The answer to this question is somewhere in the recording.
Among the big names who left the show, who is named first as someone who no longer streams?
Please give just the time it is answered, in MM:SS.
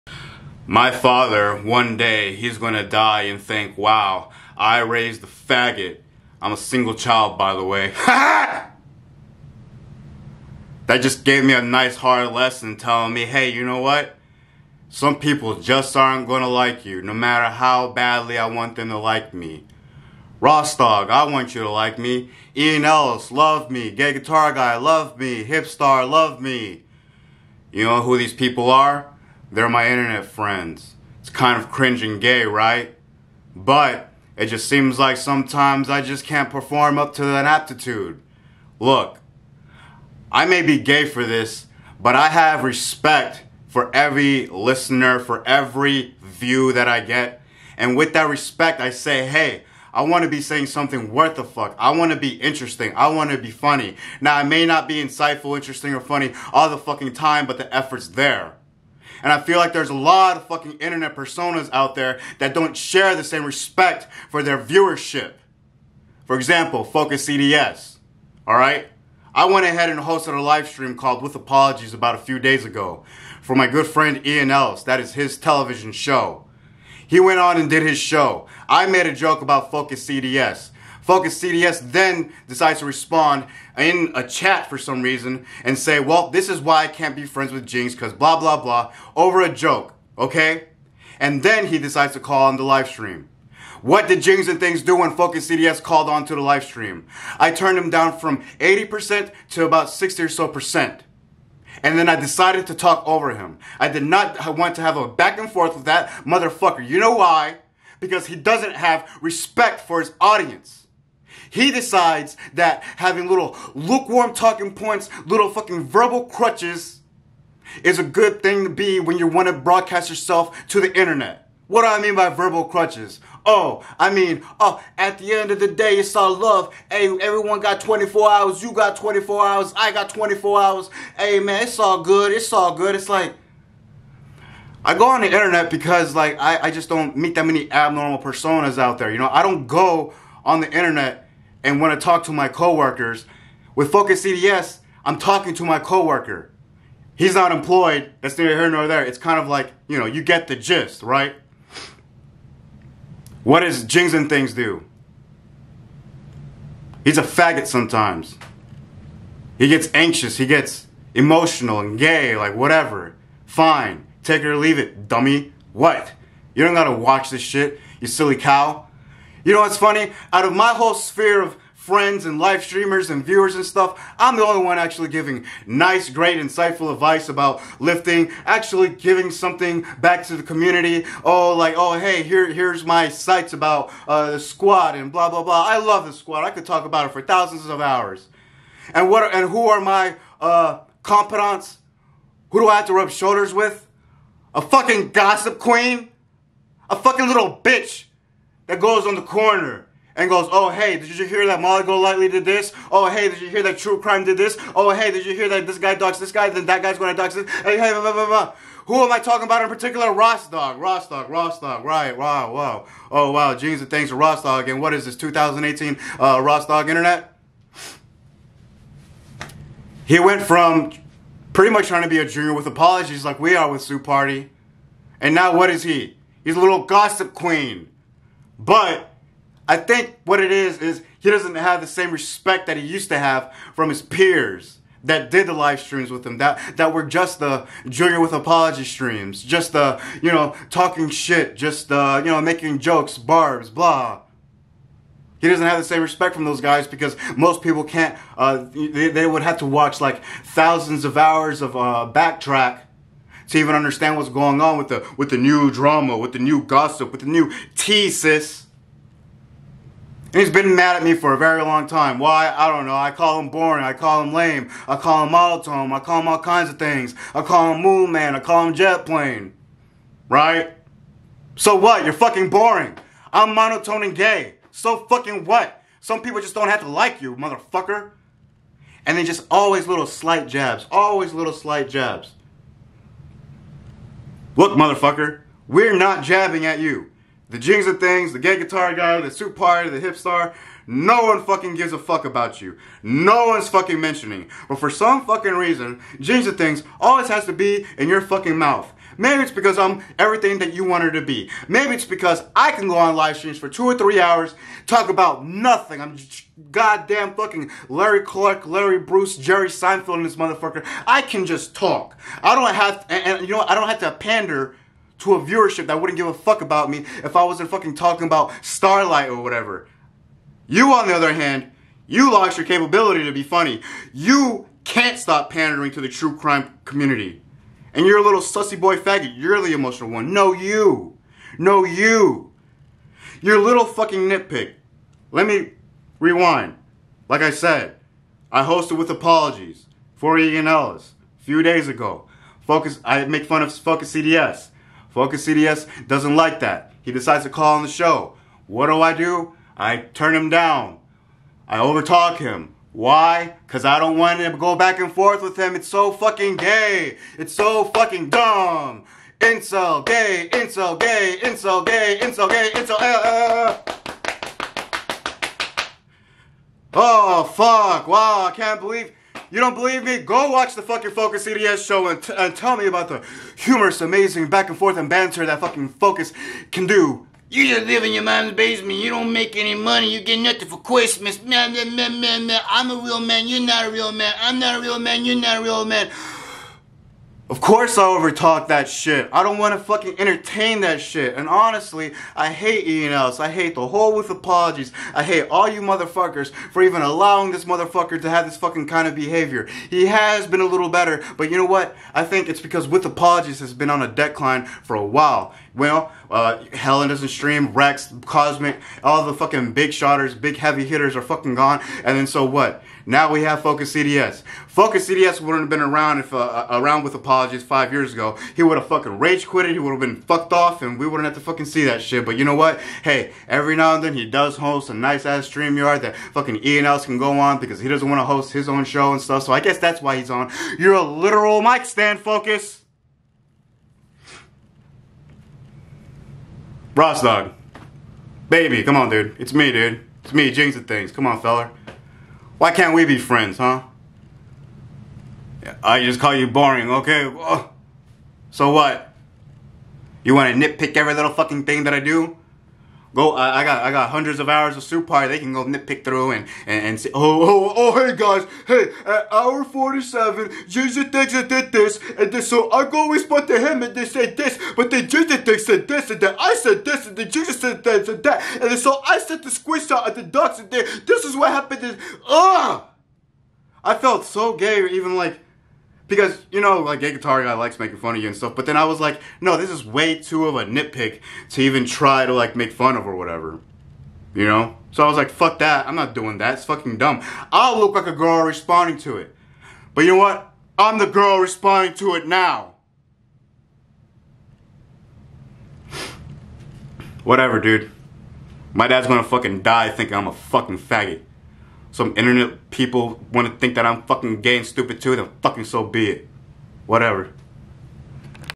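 06:46.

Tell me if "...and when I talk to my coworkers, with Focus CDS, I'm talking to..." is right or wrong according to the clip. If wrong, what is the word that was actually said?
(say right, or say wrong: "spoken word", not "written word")
right.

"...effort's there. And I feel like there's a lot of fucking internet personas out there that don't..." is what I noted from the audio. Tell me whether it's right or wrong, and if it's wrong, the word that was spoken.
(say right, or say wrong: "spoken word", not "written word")
right.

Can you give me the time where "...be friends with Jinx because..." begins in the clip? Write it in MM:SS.
01:27.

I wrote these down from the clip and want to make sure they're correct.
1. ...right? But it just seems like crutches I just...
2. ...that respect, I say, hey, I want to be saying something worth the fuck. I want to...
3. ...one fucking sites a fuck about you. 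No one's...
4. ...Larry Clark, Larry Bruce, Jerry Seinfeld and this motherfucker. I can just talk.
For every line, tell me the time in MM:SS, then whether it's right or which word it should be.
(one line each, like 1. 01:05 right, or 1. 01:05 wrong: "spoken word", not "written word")
1. 00:32 wrong: "sometimes", not "crutches"
2. 00:48 right
3. 04:51 wrong: "gives", not "sites"
4. 05:07 right.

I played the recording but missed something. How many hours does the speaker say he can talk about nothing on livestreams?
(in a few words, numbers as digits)
2 or 3.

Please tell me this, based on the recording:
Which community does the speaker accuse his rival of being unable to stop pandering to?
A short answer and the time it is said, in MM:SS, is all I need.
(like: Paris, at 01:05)
true crime community, at 05:26.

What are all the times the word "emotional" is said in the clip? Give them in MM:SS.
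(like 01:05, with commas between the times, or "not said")
02:41, 05:29.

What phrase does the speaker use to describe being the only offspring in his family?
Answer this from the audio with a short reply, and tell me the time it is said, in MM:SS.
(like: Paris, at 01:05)
single child, at 00:06.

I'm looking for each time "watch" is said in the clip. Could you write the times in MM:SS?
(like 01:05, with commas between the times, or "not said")
02:46, 04:09, 06:10.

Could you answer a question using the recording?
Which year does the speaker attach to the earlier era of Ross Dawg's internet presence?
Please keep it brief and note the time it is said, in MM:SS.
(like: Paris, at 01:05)
2018, at 03:35.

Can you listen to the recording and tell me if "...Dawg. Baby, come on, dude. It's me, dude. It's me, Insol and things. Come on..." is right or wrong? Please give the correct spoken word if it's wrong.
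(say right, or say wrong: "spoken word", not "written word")
wrong: "Jings", not "Insol".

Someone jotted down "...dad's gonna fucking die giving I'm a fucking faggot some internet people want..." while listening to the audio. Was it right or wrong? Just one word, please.
wrong.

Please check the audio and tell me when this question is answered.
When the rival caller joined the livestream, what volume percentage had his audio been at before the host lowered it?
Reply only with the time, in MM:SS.
01:38.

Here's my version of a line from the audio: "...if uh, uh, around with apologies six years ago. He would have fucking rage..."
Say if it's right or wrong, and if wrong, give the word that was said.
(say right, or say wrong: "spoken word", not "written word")
wrong: "five", not "six".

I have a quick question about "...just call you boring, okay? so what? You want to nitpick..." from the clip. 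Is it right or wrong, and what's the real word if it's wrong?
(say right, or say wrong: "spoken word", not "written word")
right.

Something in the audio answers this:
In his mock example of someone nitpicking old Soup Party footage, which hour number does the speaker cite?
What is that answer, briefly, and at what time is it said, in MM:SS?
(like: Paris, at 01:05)
47, at 07:39.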